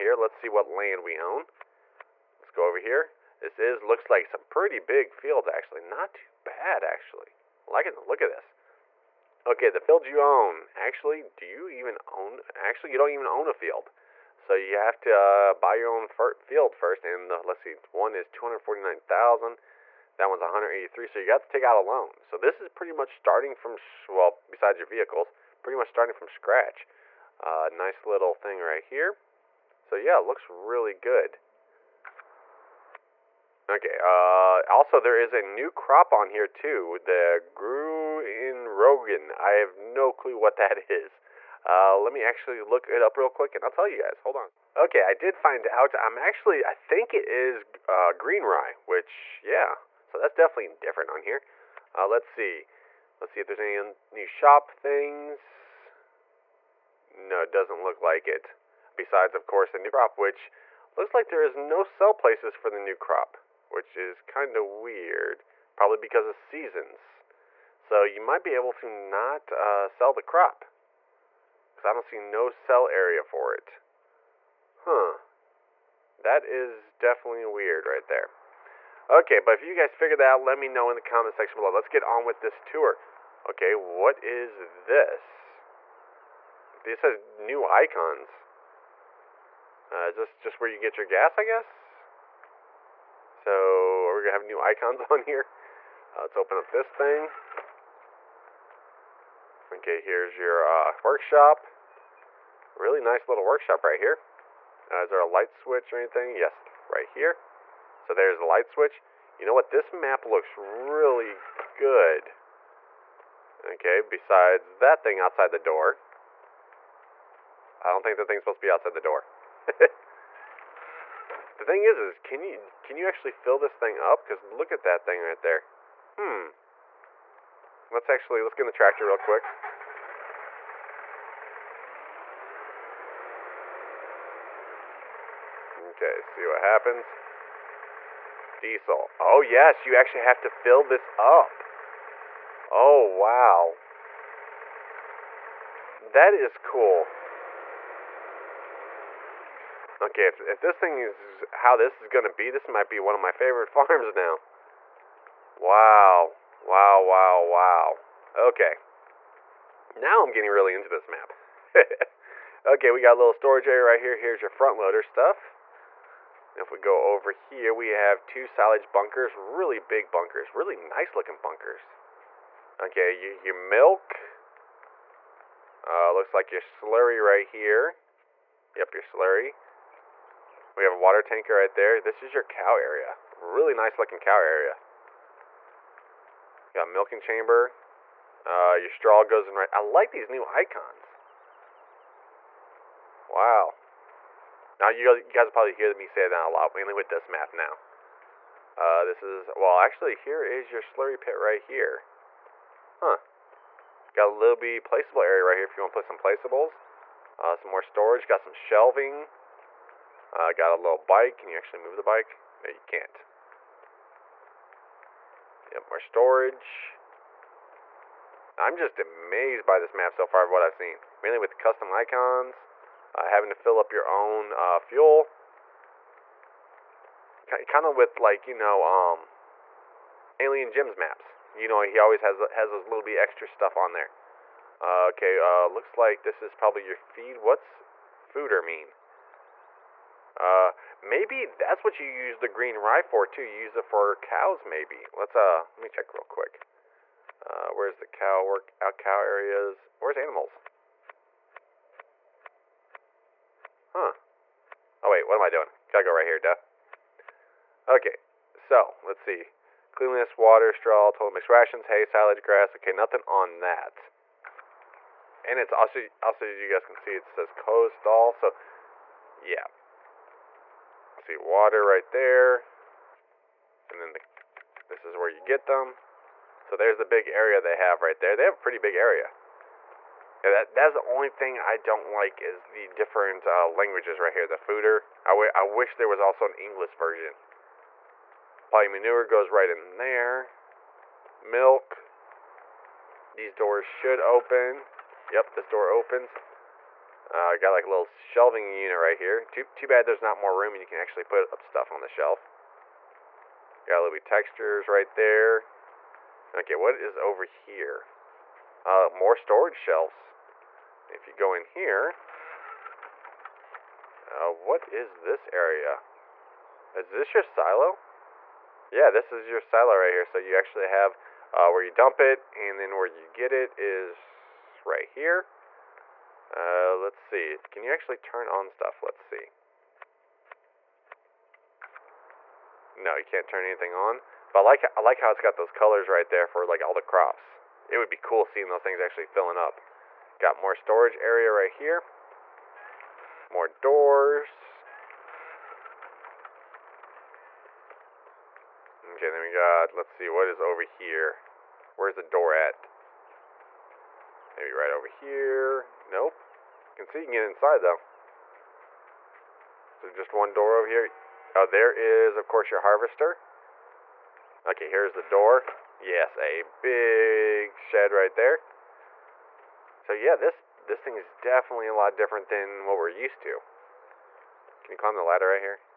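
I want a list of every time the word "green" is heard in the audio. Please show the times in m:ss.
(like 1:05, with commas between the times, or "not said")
0:48, 4:02.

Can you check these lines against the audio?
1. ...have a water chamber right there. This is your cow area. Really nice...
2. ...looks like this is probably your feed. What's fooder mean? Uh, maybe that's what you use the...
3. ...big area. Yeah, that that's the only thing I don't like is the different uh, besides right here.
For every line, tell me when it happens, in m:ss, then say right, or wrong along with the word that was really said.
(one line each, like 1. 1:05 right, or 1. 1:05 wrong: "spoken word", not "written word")
1. 3:00 wrong: "tanker", not "chamber"
2. 3:55 right
3. 4:38 wrong: "languages", not "besides".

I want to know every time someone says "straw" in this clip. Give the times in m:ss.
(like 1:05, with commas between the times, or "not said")
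3:08, 4:20.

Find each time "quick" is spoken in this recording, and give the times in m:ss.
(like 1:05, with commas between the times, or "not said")
0:43, 2:09, 4:06.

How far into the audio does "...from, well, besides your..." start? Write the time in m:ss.
0:23.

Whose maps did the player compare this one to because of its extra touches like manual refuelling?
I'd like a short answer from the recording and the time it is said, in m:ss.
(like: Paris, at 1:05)
Alien Jim, at 3:50.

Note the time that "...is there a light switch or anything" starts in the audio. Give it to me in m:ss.
1:44.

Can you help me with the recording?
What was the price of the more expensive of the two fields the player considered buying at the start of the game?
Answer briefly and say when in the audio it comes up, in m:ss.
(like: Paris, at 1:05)
249,000, at 0:18.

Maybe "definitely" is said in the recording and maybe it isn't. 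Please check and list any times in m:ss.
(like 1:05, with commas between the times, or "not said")
0:50, 1:16, 6:11.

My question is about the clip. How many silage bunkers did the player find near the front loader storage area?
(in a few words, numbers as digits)
2.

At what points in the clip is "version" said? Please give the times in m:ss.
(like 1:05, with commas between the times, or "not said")
4:46.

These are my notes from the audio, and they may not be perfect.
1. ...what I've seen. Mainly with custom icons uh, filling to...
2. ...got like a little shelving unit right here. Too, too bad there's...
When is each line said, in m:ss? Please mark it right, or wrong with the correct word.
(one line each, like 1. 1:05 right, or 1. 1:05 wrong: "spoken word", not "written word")
1. 3:40 wrong: "having", not "filling"
2. 4:57 right.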